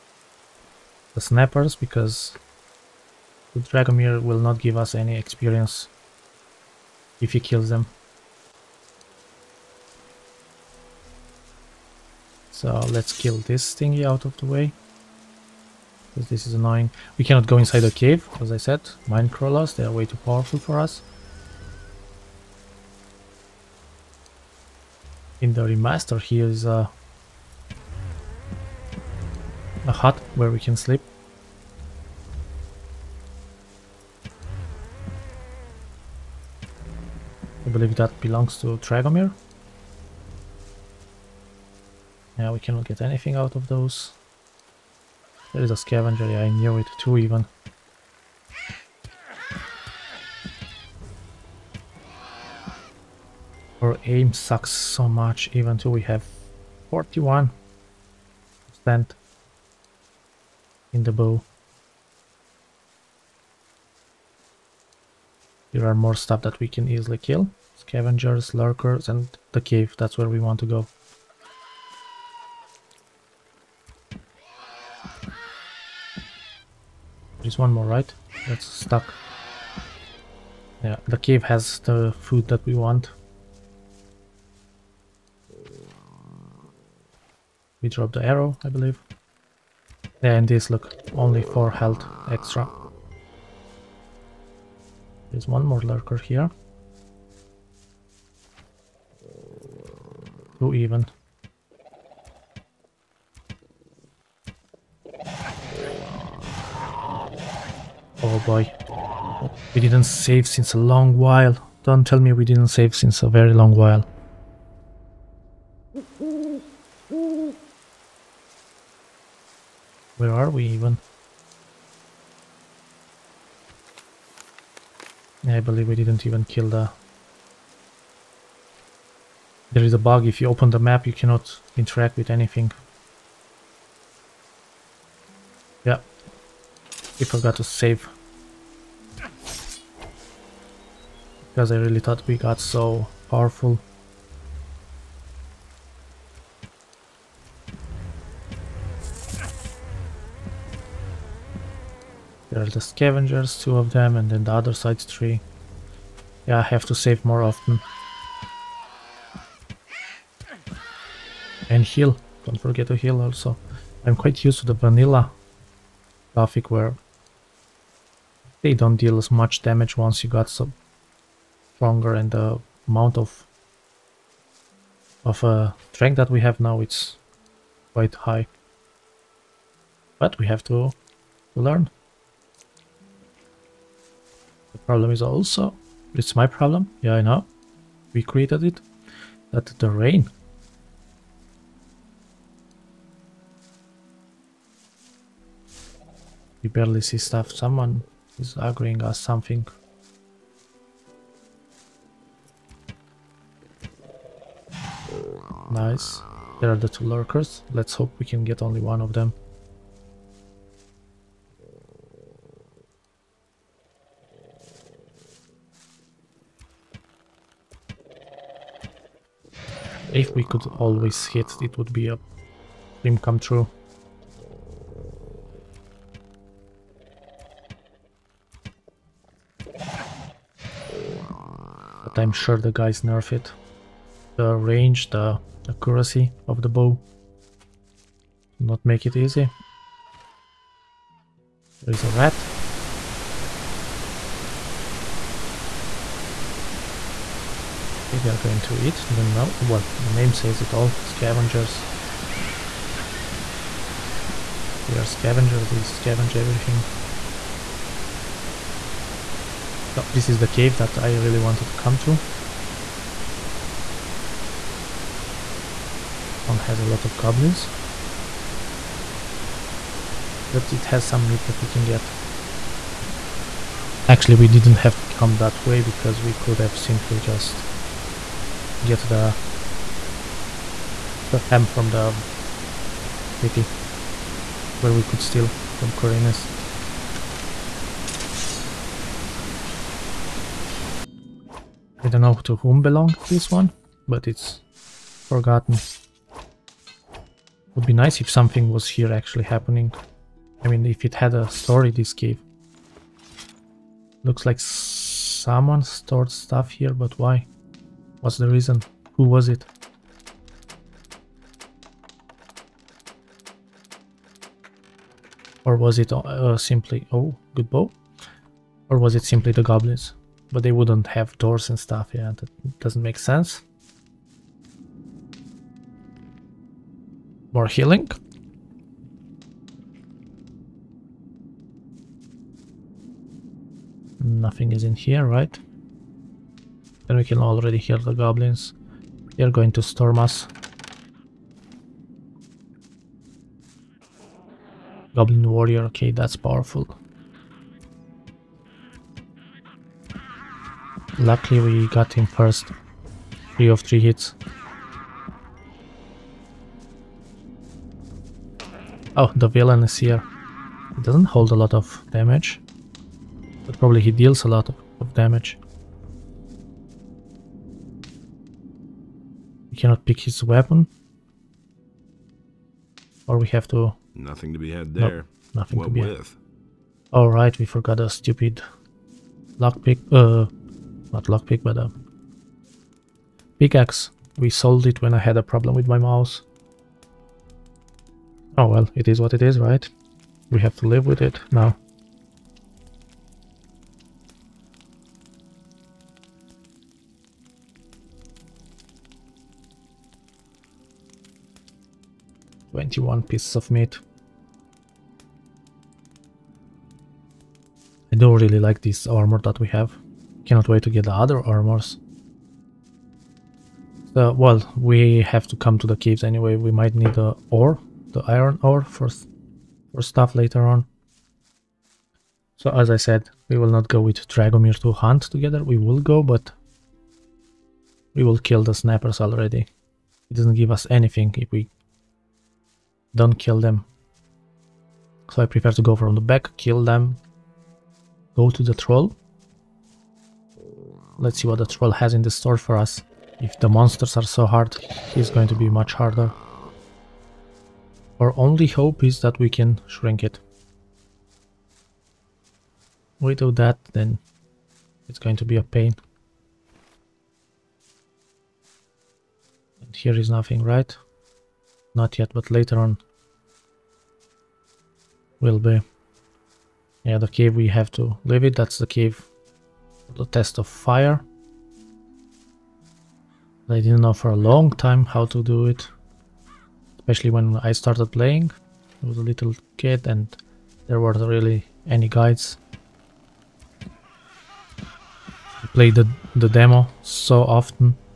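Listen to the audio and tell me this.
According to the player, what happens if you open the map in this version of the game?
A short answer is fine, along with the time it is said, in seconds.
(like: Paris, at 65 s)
cannot interact with anything, at 131 s.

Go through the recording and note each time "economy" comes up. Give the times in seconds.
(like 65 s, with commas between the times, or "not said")
not said.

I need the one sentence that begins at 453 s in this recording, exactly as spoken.
We do that, then it's going to be a pain.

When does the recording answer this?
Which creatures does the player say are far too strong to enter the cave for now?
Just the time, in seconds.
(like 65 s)
19 s.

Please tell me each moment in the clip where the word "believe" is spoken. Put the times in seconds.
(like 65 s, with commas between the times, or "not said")
37 s, 88 s, 125 s.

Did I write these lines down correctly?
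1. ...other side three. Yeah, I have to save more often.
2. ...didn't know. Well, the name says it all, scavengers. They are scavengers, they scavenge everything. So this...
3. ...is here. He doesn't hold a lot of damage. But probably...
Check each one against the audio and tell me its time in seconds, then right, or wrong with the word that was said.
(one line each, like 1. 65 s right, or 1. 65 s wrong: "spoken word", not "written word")
1. 154 s right
2. 249 s right
3. 359 s right.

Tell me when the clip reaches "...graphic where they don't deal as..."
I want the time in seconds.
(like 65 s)
166 s.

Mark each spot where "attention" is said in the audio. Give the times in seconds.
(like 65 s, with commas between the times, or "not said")
not said.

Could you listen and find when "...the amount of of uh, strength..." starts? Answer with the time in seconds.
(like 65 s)
172 s.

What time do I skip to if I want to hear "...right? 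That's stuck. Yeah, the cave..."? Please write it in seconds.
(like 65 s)
77 s.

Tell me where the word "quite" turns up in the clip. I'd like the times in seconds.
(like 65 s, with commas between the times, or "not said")
164 s, 177 s.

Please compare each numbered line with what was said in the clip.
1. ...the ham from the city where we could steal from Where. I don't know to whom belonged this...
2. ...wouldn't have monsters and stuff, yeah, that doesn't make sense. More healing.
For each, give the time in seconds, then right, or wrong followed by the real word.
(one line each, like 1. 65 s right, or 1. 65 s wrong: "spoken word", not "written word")
1. 281 s wrong: "Khorinis", not "Where"
2. 320 s wrong: "doors", not "monsters".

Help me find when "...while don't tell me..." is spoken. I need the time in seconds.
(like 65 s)
111 s.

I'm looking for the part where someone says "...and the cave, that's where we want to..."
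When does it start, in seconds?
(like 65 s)
69 s.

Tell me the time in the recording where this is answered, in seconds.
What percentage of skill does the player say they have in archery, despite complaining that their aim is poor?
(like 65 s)
56 s.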